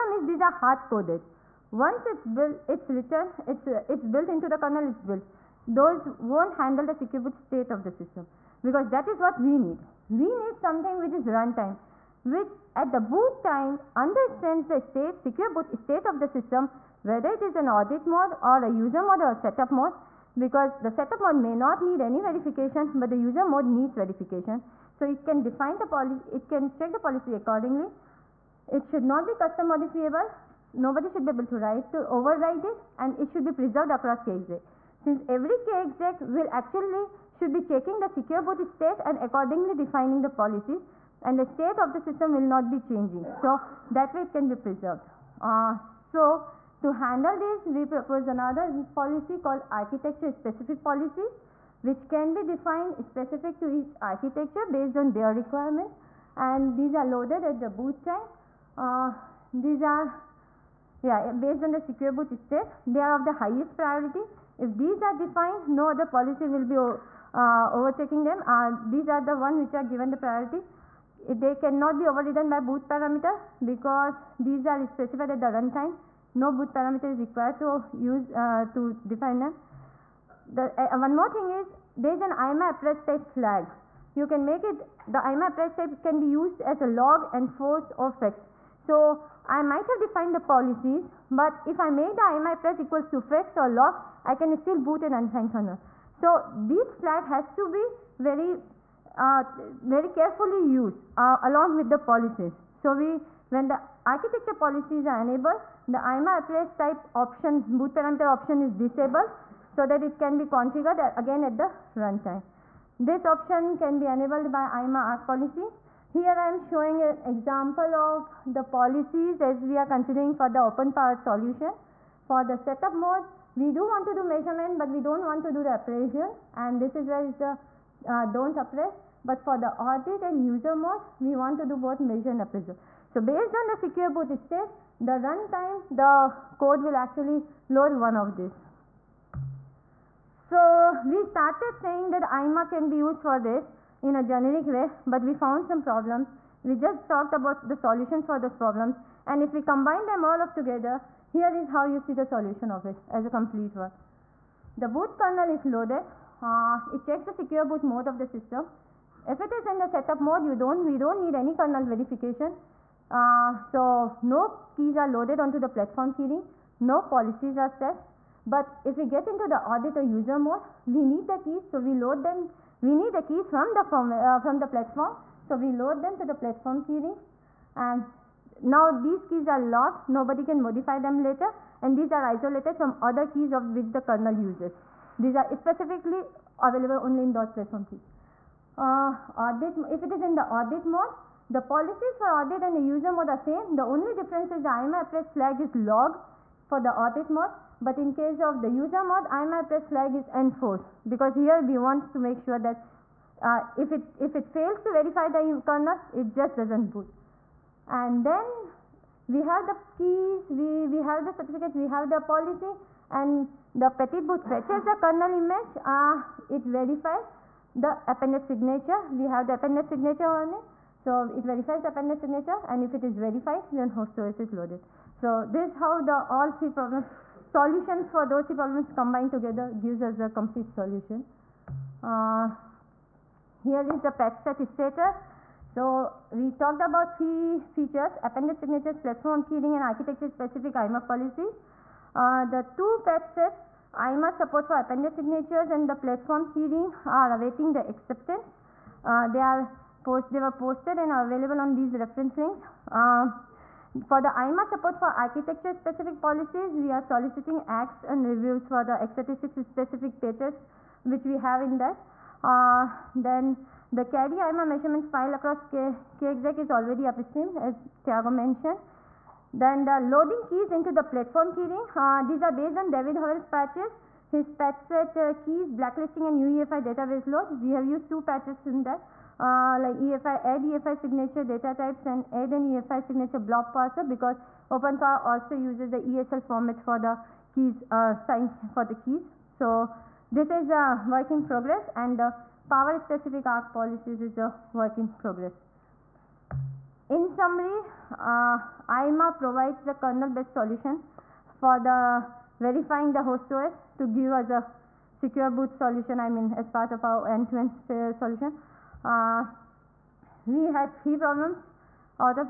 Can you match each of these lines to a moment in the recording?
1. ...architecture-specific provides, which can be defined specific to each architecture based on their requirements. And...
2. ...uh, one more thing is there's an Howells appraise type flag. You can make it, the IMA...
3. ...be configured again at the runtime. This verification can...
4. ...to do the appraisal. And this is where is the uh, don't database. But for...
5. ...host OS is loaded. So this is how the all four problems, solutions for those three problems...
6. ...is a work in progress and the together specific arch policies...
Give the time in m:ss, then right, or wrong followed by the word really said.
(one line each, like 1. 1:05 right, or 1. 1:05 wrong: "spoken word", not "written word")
1. 0:49 wrong: "policies", not "provides"
2. 1:20 wrong: "IMA", not "Howells"
3. 1:50 wrong: "option", not "verification"
4. 2:05 wrong: "appraise", not "database"
5. 3:43 wrong: "three", not "four"
6. 4:50 wrong: "power", not "together".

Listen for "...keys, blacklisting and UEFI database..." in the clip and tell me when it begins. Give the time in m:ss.
4:35.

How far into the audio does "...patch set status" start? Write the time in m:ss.
3:54.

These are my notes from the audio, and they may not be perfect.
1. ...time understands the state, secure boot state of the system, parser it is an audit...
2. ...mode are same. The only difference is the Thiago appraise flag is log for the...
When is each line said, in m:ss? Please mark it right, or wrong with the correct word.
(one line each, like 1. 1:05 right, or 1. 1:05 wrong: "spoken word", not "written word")
1. 0:13 wrong: "whether", not "parser"
2. 3:13 wrong: "IMA", not "Thiago".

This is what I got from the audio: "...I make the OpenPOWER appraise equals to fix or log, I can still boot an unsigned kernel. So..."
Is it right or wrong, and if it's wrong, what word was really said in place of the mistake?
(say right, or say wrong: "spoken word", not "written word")
wrong: "IMA", not "OpenPOWER".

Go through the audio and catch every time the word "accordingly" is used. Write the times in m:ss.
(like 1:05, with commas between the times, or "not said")
0:27, 0:39.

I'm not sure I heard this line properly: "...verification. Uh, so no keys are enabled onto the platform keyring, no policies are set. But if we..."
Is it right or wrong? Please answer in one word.
wrong.